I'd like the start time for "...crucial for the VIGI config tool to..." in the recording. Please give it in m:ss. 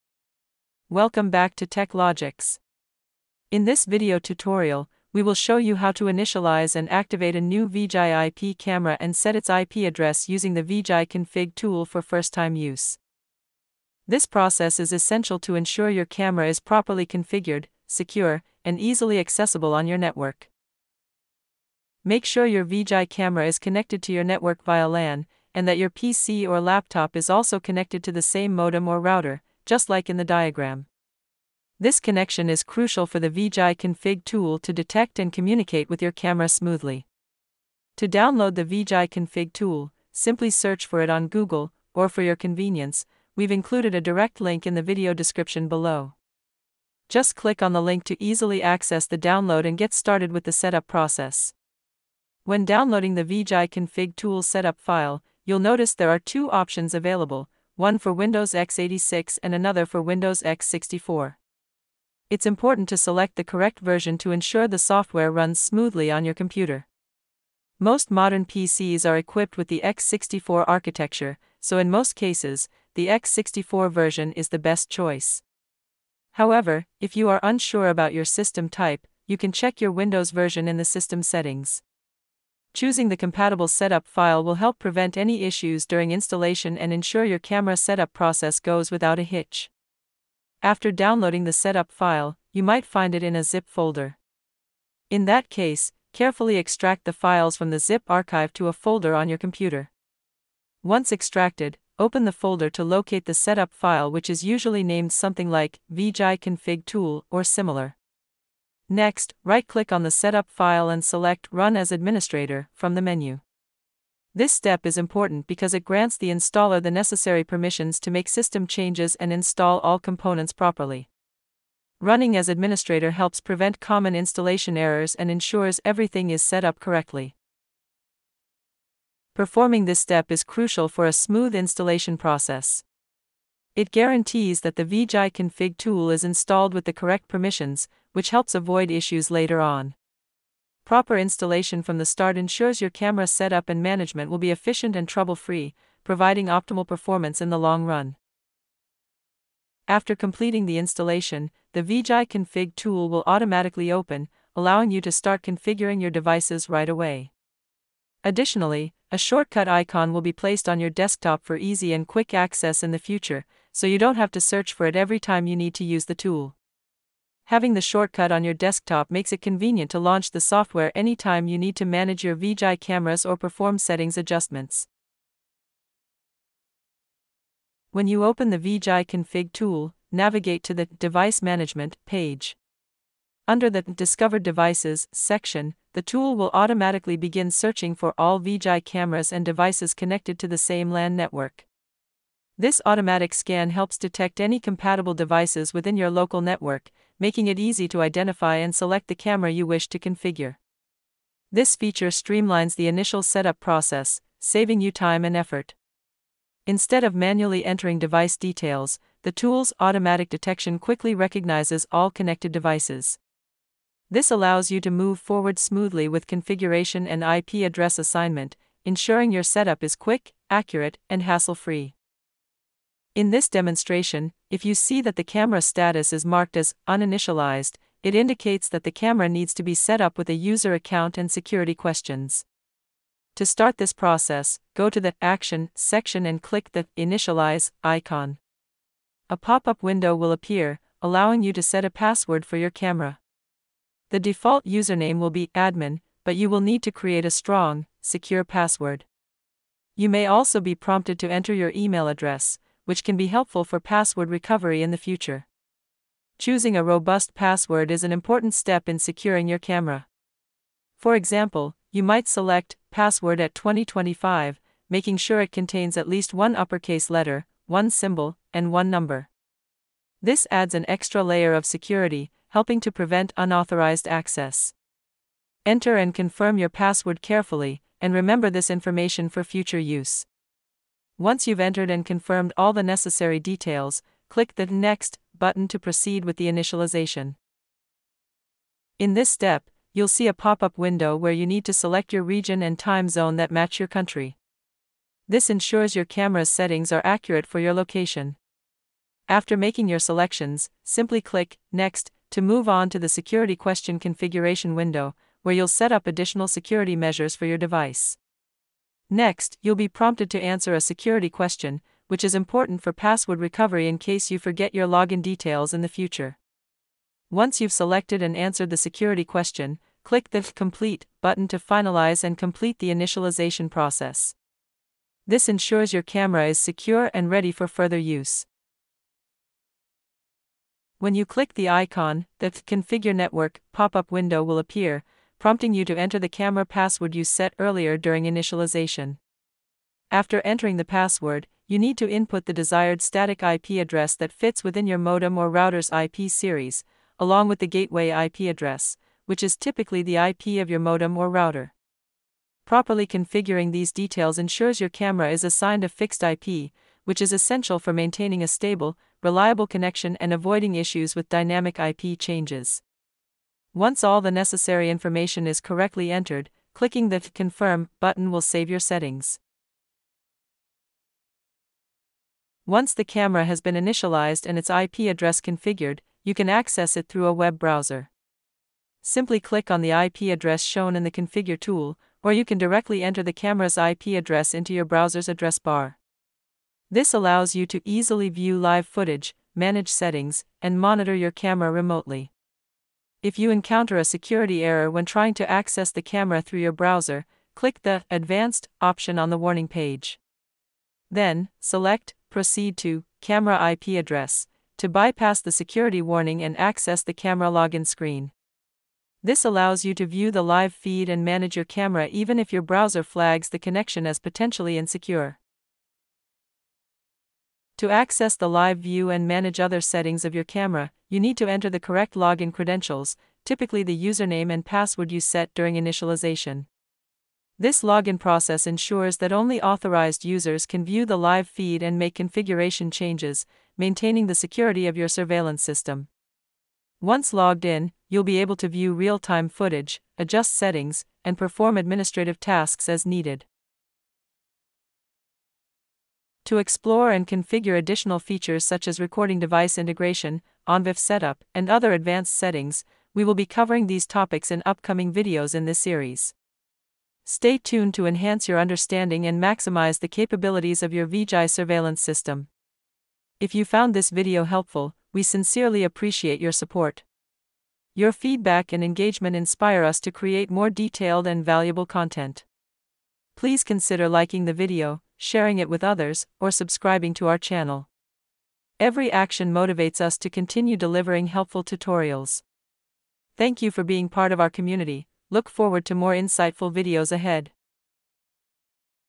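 0:32.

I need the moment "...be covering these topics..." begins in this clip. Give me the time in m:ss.
7:33.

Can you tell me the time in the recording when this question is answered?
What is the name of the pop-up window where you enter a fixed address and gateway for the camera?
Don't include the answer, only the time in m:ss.
5:32.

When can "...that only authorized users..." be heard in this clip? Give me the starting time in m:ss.
7:09.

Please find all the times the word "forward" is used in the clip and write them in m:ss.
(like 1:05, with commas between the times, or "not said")
3:35, 8:05.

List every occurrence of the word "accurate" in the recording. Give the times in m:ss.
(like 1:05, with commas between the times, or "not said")
3:40, 4:57.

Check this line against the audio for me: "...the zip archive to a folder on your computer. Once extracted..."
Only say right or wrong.
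right.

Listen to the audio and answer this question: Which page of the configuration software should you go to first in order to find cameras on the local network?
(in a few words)
Device Management.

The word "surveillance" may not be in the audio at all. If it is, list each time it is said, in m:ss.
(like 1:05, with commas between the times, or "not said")
7:15, 7:41.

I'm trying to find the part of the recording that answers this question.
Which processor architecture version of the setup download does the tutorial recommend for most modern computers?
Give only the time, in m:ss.
1:13.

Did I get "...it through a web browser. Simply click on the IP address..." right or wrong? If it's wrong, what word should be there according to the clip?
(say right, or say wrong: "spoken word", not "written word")
right.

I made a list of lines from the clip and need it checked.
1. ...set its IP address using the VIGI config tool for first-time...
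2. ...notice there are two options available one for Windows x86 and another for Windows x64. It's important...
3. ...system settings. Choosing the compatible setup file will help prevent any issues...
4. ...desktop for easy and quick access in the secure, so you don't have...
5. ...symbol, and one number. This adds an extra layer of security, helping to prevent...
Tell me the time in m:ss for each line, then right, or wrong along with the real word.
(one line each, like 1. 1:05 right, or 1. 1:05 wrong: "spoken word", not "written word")
1. 0:09 right
2. 0:55 right
3. 1:20 right
4. 2:40 wrong: "future", not "secure"
5. 4:27 right.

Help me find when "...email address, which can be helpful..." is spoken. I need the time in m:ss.
4:11.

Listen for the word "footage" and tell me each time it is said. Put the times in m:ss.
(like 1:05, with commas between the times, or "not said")
6:28, 7:19.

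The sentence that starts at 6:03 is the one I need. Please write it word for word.
Once all the necessary information is correctly entered, clicking the Confirm button will save your settings.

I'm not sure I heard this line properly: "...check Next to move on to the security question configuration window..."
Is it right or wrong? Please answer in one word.
wrong.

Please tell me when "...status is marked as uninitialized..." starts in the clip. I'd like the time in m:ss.
3:45.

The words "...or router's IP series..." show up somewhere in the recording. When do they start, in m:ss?
5:45.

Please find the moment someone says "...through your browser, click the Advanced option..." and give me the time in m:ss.
6:36.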